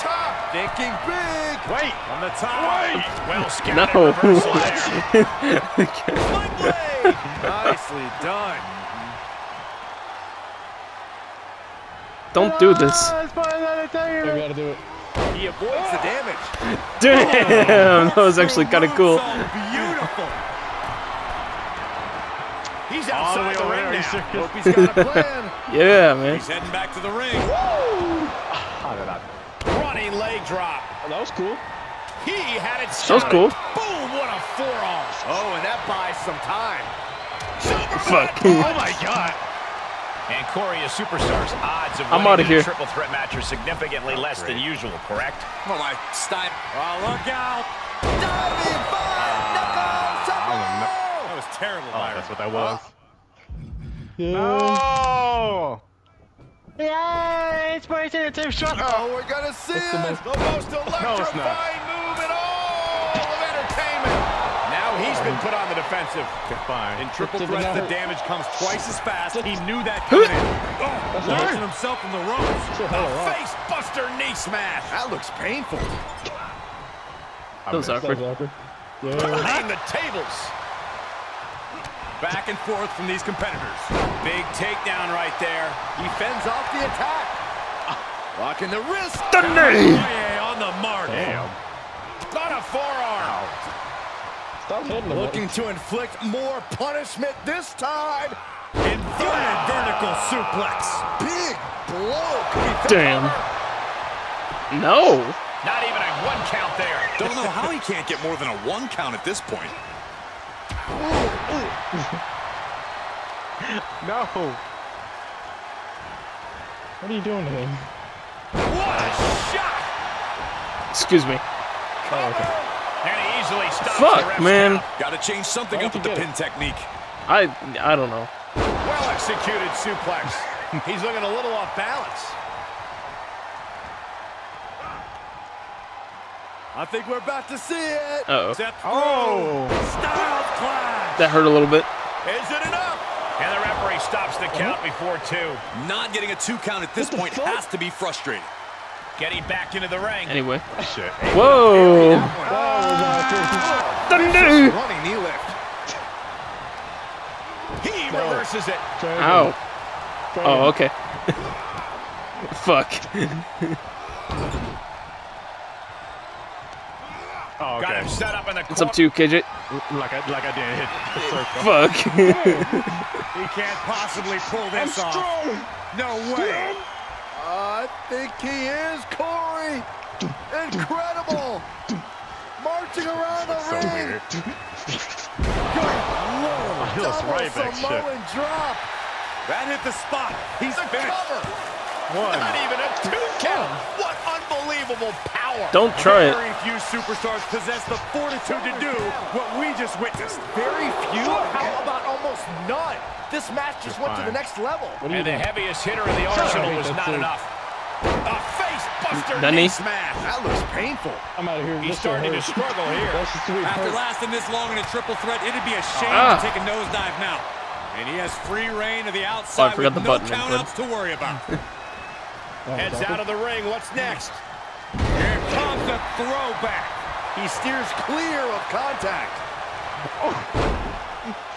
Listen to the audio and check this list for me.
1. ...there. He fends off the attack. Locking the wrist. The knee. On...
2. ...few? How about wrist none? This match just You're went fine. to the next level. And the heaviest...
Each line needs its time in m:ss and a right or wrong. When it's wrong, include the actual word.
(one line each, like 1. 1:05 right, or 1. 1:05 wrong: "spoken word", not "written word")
1. 1:25 right
2. 3:21 wrong: "almost", not "wrist".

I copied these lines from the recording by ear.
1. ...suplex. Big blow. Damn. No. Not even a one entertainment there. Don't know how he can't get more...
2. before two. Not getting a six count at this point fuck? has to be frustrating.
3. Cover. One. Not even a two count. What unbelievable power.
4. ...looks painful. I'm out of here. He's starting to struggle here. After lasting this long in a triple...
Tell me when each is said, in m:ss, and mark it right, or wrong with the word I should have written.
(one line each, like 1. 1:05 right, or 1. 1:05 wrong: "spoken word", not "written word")
1. 1:40 wrong: "count", not "entertainment"
2. 2:24 wrong: "two", not "six"
3. 3:11 right
4. 3:30 right.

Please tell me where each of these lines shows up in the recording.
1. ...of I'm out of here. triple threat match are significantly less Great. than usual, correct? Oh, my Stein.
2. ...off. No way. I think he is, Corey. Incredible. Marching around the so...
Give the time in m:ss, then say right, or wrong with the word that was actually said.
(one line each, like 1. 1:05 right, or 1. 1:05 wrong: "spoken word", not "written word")
1. 0:41 right
2. 2:55 right.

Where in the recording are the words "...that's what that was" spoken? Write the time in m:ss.
0:52.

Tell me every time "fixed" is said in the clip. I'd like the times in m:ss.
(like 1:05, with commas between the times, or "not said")
not said.